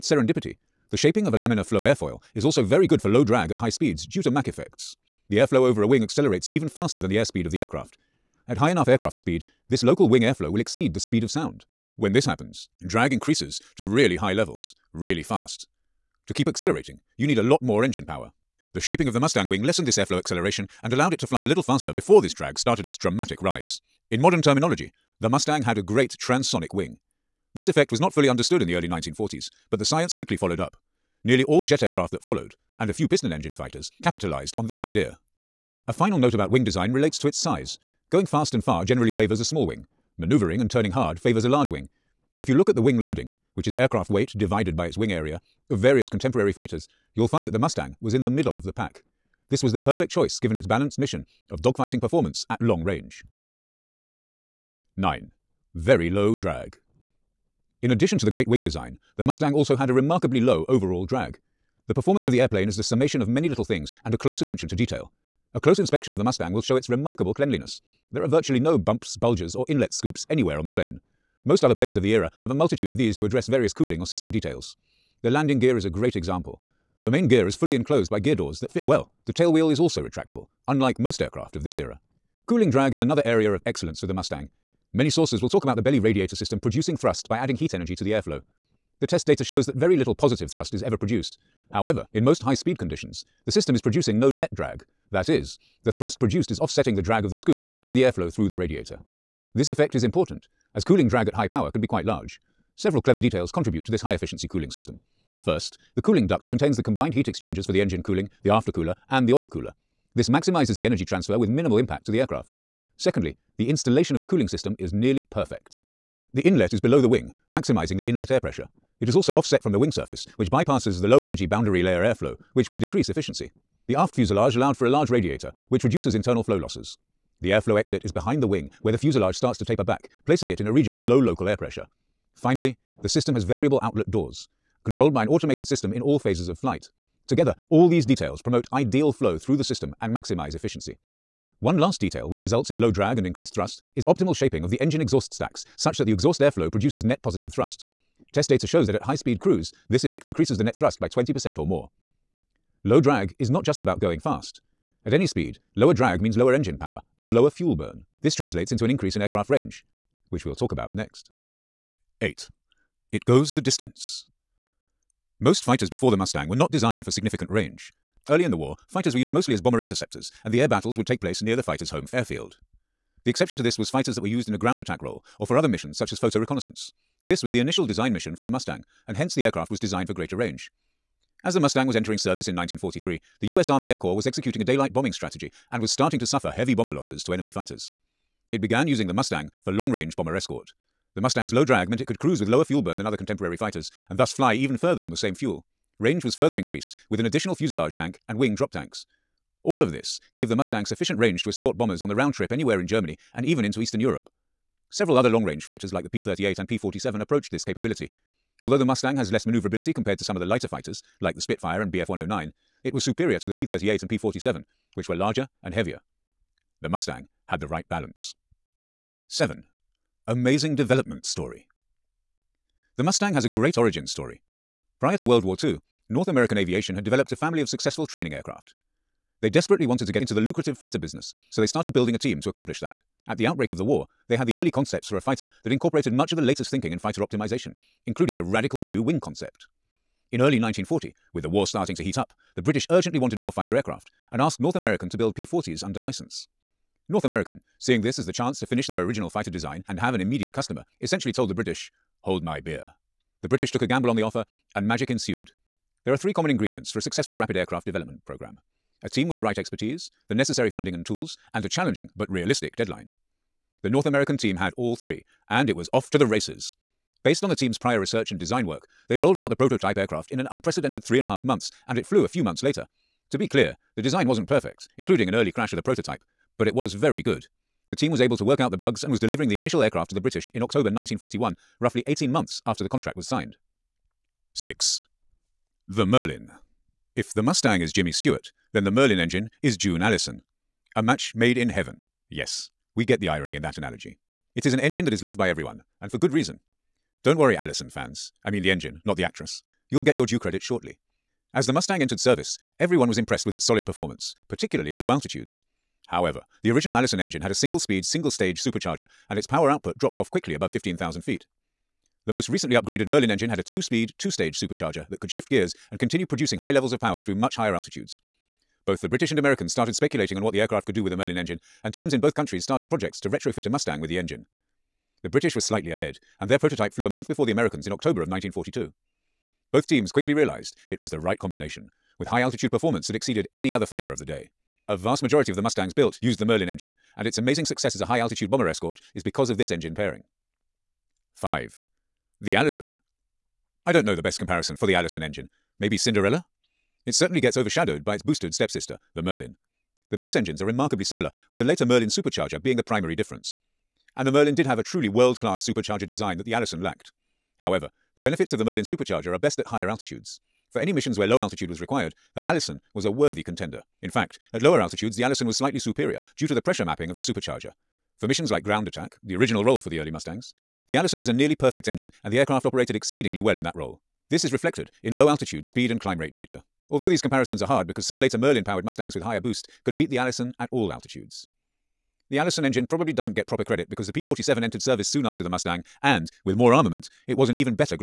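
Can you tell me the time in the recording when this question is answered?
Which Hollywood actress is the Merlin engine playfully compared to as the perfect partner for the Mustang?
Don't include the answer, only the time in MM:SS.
04:49.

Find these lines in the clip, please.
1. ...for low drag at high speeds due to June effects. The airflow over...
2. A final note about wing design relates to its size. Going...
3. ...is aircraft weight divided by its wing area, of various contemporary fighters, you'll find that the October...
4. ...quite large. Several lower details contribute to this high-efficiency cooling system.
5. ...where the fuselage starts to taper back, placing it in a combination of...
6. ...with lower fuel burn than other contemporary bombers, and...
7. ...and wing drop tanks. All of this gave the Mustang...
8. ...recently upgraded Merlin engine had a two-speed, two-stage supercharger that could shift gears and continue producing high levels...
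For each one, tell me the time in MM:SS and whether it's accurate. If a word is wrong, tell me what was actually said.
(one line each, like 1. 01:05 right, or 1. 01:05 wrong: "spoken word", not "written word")
1. 00:02 wrong: "Mach", not "June"
2. 00:35 right
3. 00:43 wrong: "Mustang", not "October"
4. 01:41 wrong: "clever", not "lower"
5. 02:08 wrong: "region", not "combination"
6. 03:12 wrong: "fighters", not "bombers"
7. 03:18 right
8. 05:12 right.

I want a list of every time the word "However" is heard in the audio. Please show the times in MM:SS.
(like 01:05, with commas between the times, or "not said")
01:31, 05:06, 05:57.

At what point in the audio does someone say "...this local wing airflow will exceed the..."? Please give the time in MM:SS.
00:09.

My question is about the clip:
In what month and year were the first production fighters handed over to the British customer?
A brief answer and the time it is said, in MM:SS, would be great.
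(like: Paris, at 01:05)
October 1941, at 04:40.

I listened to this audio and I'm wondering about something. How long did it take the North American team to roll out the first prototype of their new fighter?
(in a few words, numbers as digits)
3.5 months.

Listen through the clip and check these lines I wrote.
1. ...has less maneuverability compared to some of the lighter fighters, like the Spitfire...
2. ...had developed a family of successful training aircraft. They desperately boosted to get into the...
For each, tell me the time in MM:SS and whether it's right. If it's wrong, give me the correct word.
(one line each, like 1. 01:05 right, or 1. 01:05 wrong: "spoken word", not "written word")
1. 03:29 right
2. 03:46 wrong: "wanted", not "boosted".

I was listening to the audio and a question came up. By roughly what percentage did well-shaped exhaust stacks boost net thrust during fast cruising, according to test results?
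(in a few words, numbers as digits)
20%.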